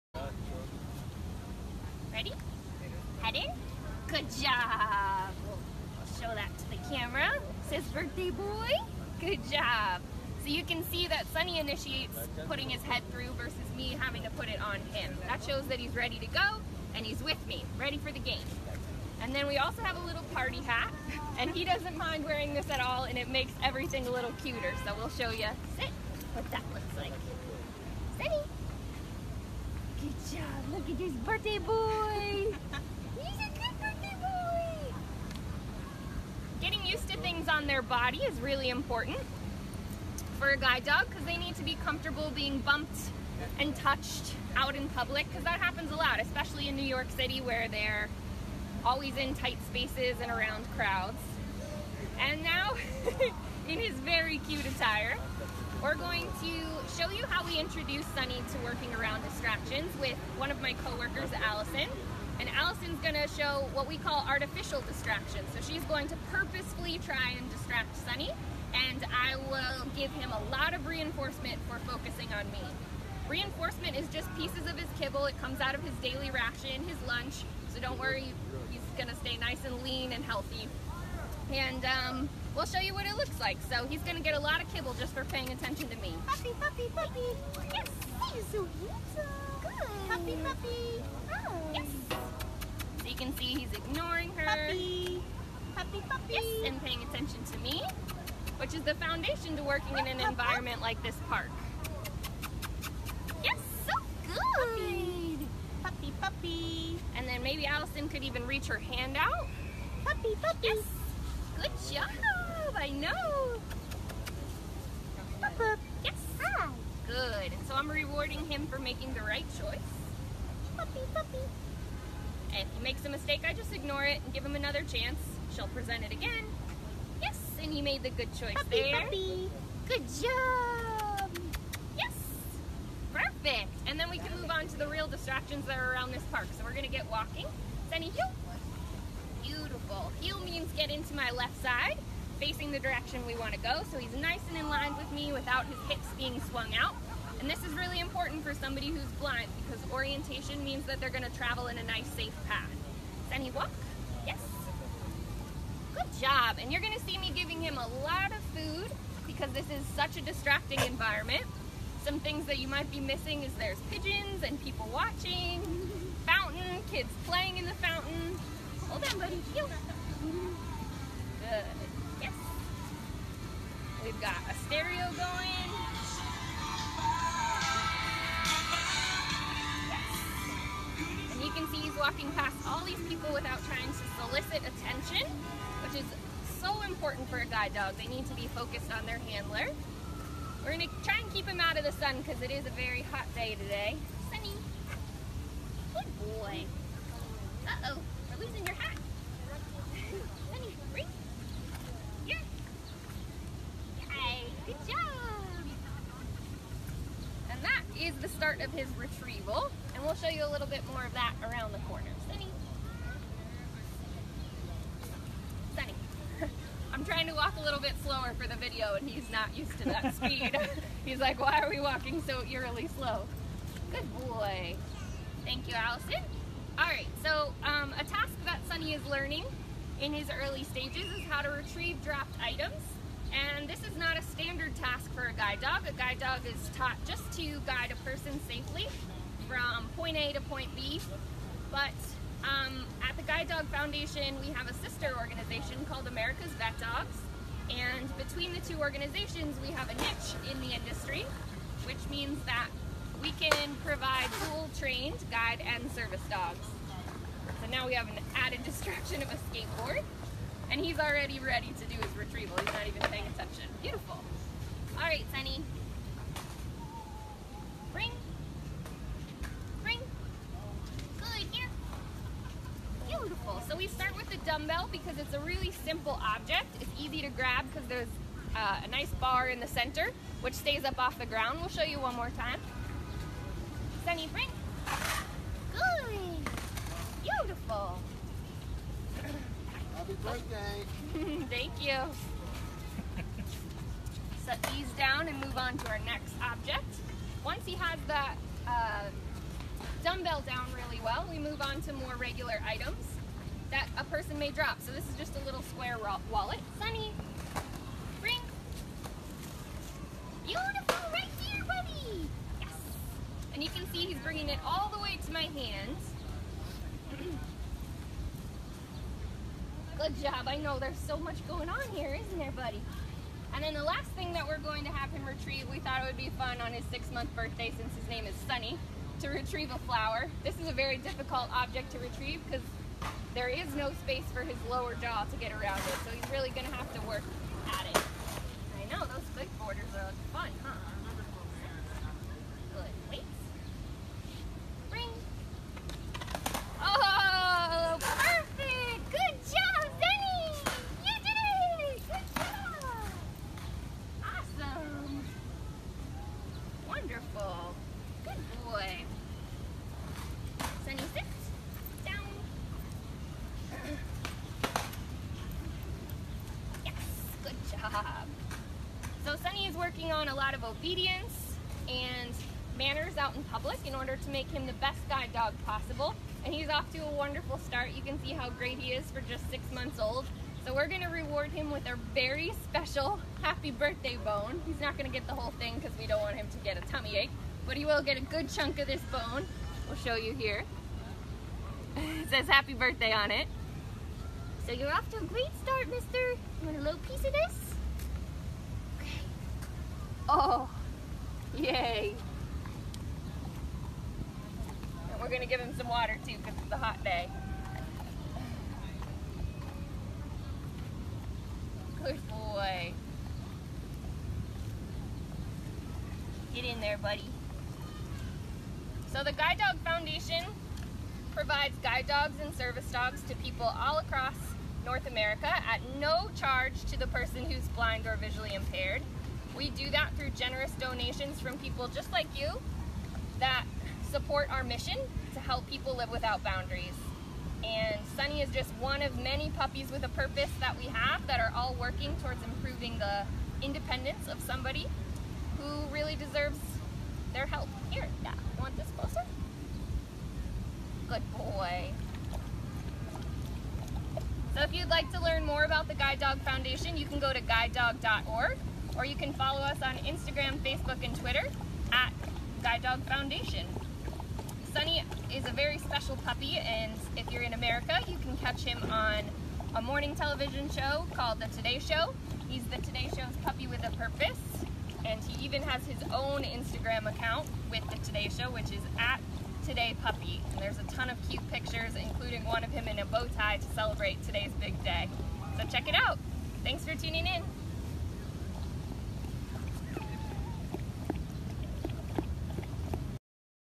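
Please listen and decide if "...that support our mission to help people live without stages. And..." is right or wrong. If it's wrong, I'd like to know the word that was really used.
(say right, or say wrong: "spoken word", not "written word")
wrong: "boundaries", not "stages".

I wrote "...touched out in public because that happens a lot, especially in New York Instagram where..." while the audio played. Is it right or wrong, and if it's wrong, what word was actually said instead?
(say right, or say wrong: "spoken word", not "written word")
wrong: "City", not "Instagram".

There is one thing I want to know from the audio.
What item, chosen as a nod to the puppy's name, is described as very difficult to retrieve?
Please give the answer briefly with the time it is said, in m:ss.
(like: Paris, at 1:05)
A flower, at 5:29.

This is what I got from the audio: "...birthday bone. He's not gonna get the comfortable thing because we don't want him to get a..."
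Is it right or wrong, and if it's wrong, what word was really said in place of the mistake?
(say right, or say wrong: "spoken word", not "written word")
wrong: "whole", not "comfortable".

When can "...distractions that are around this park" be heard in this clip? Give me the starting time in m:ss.
2:15.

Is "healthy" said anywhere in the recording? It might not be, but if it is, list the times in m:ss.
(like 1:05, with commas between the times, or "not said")
1:20.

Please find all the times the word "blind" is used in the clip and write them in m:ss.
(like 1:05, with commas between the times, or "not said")
2:29, 7:07.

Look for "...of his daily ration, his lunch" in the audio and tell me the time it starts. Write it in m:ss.
1:15.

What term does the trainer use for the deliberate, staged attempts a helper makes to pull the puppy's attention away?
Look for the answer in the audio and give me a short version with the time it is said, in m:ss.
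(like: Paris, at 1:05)
Artificial distractions, at 1:04.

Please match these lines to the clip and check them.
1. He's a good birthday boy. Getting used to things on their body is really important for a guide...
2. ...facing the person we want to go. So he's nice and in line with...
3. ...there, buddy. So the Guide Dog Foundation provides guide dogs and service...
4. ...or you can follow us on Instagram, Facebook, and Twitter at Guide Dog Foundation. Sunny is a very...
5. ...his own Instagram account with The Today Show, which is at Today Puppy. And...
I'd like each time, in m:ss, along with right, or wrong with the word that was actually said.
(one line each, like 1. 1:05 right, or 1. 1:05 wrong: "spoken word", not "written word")
1. 0:32 right
2. 2:22 wrong: "direction", not "person"
3. 6:56 right
4. 7:38 right
5. 7:55 right.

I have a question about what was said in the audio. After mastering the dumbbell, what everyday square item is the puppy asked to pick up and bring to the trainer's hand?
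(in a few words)
Wallet.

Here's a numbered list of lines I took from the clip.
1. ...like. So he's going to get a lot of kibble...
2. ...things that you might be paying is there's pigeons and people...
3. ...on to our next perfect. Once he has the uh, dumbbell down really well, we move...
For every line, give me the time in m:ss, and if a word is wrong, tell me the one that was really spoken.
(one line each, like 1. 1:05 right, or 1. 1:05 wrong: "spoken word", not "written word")
1. 1:23 right
2. 2:42 wrong: "missing", not "paying"
3. 4:55 wrong: "object", not "perfect".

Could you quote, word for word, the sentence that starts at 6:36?
You want a little piece of this?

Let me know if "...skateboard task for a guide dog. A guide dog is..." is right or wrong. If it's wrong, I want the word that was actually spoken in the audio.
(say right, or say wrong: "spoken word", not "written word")
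wrong: "standard", not "skateboard".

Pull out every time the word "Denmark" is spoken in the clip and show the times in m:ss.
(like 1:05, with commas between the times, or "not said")
not said.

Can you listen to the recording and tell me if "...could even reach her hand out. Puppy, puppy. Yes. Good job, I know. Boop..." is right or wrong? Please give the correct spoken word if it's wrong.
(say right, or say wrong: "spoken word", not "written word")
right.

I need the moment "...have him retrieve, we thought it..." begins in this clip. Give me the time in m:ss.
5:24.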